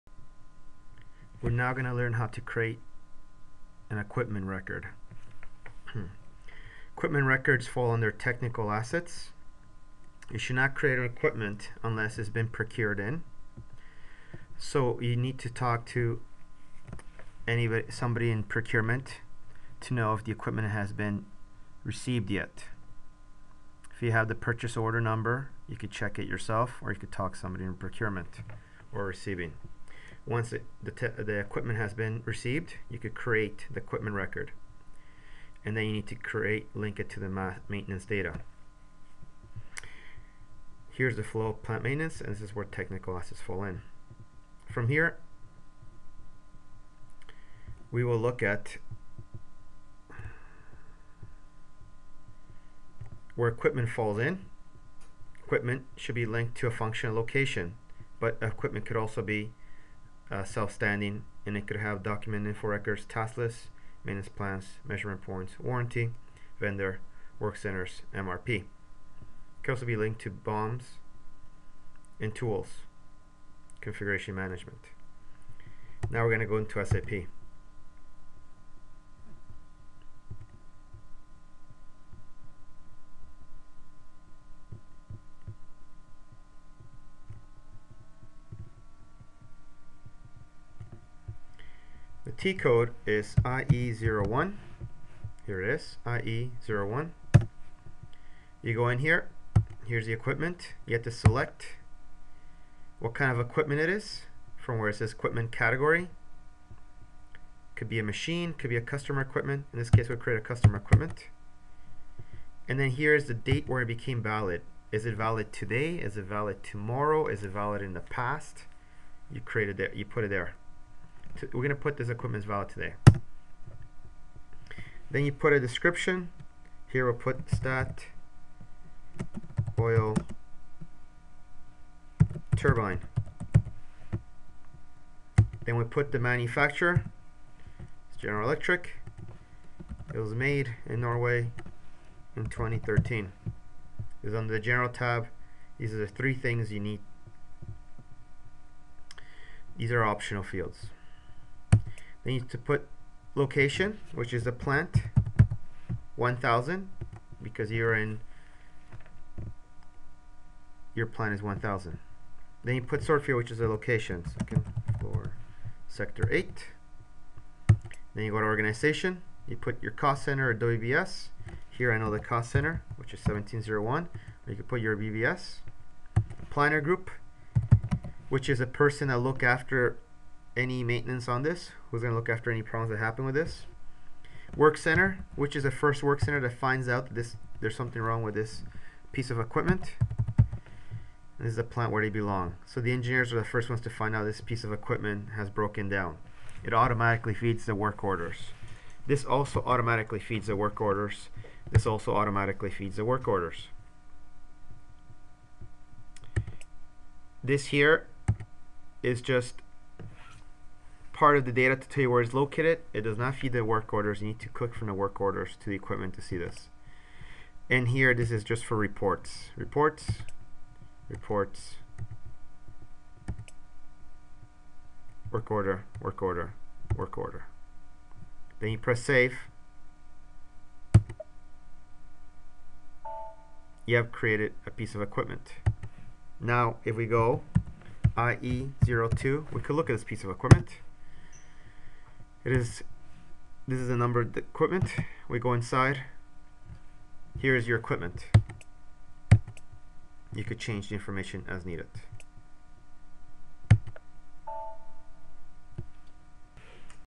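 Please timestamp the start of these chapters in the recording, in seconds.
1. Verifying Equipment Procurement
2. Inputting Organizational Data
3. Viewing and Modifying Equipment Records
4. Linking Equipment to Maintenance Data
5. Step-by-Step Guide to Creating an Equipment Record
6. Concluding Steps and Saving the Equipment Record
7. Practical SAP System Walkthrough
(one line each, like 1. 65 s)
1. 16 s
2. 124 s
3. 235 s
4. 60 s
5. 33 s
6. 180 s
7. 88 s.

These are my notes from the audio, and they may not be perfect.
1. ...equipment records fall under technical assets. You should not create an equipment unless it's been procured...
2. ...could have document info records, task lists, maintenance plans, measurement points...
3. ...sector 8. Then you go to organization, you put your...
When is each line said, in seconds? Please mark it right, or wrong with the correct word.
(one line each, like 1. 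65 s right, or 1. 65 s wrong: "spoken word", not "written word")
1. 6 s right
2. 61 s right
3. 165 s right.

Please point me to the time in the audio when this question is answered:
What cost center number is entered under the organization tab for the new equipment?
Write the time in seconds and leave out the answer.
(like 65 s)
173 s.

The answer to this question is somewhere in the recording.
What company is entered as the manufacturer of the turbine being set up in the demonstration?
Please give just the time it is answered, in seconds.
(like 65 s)
138 s.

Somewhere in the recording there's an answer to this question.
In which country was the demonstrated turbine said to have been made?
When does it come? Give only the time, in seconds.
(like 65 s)
141 s.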